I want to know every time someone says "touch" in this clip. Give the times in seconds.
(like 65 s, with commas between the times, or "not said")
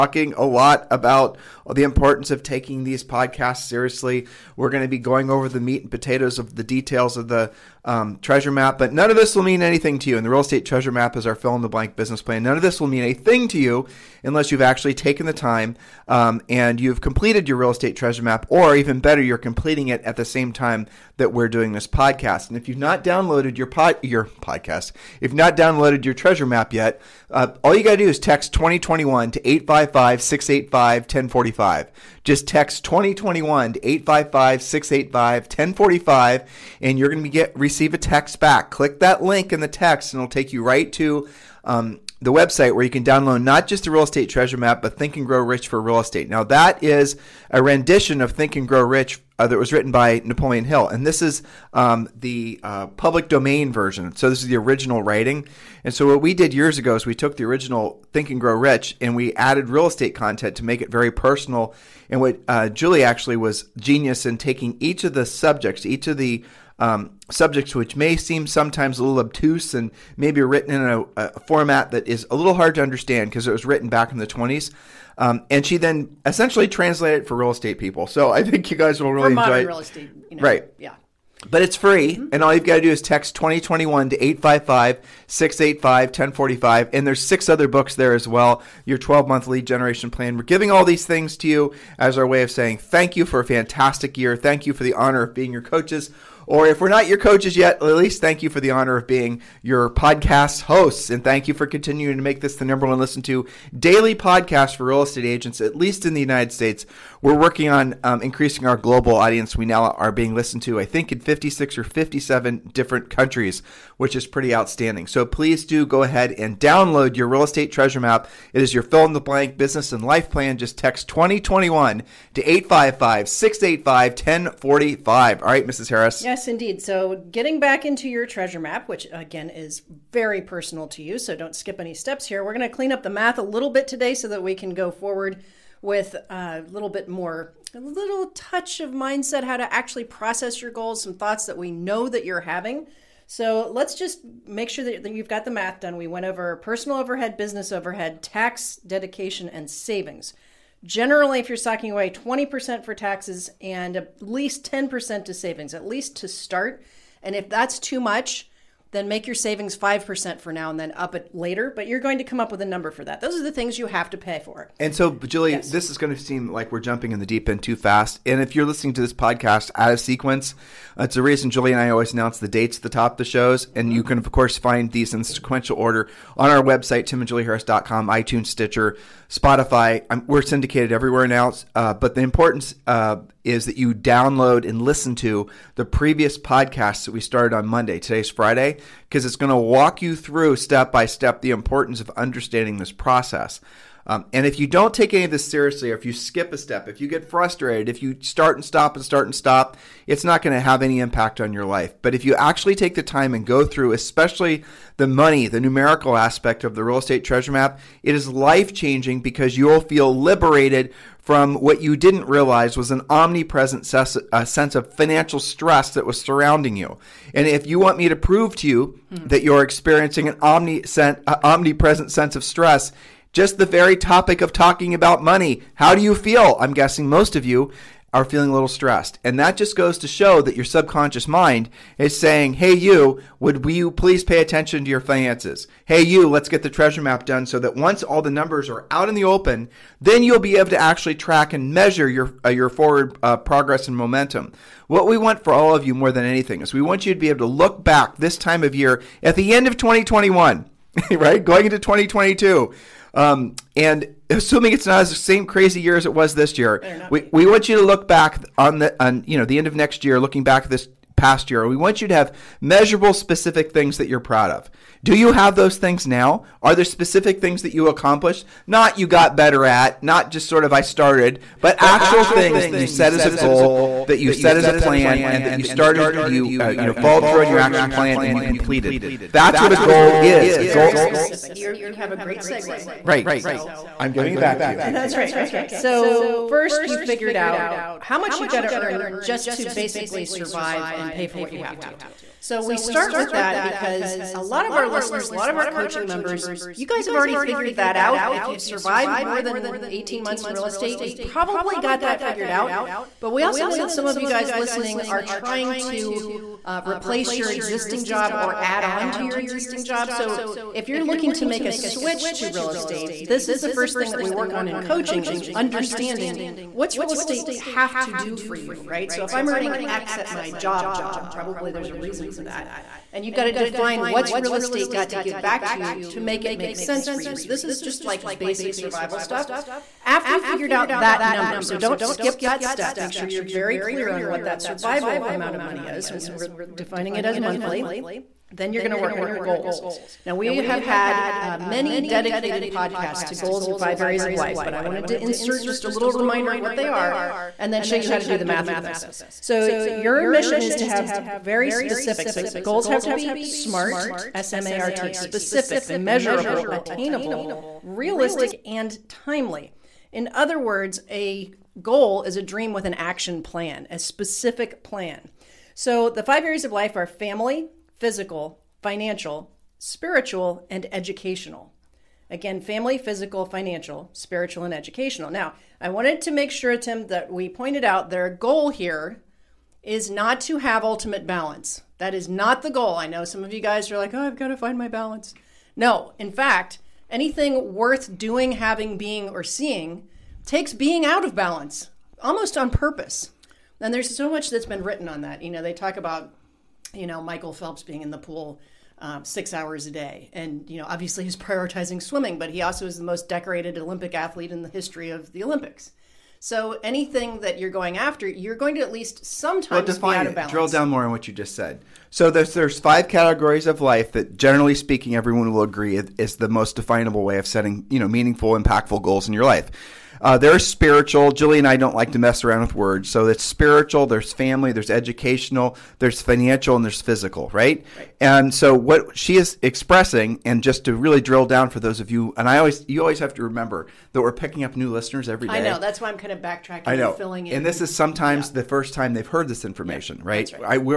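138 s.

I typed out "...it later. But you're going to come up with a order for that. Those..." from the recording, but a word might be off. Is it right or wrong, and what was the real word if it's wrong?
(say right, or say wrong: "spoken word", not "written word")
wrong: "number", not "order".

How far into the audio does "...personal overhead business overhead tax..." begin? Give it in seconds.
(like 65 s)
146 s.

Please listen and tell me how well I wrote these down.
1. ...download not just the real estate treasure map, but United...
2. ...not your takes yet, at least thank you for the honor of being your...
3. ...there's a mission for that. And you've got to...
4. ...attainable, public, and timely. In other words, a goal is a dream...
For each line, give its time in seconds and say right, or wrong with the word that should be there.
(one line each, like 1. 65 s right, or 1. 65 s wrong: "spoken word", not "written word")
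1. 43 s wrong: "Think", not "United"
2. 96 s wrong: "coaches", not "takes"
3. 321 s wrong: "reason", not "mission"
4. 356 s wrong: "realistic", not "public".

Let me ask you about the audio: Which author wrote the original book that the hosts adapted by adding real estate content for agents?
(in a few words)
Napoleon Hill.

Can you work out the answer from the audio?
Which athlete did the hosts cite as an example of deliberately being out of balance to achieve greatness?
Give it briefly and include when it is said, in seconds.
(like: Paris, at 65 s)
Michael Phelps, at 397 s.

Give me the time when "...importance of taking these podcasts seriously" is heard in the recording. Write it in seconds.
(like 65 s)
1 s.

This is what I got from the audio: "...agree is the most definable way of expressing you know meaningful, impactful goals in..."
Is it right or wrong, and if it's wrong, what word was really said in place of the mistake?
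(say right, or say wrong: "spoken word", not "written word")
wrong: "setting", not "expressing".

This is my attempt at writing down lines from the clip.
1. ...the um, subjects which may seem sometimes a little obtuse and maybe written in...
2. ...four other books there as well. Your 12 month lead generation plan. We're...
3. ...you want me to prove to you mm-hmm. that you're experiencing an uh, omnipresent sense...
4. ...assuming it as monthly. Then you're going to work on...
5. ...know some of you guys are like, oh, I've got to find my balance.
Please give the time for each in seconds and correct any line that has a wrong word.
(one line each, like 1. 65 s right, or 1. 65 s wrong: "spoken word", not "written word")
1. 66 s right
2. 87 s wrong: "six", not "four"
3. 217 s right
4. 336 s wrong: "defining", not "assuming"
5. 383 s right.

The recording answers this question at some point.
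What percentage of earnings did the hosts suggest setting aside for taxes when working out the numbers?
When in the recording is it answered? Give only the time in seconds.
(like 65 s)
152 s.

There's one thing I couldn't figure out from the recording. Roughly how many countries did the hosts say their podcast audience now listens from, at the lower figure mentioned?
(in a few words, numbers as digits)
56.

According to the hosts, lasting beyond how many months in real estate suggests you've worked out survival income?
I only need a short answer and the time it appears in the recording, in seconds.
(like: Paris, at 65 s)
18 months, at 299 s.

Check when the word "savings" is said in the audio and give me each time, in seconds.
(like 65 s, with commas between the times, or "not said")
149 s, 155 s, 159 s.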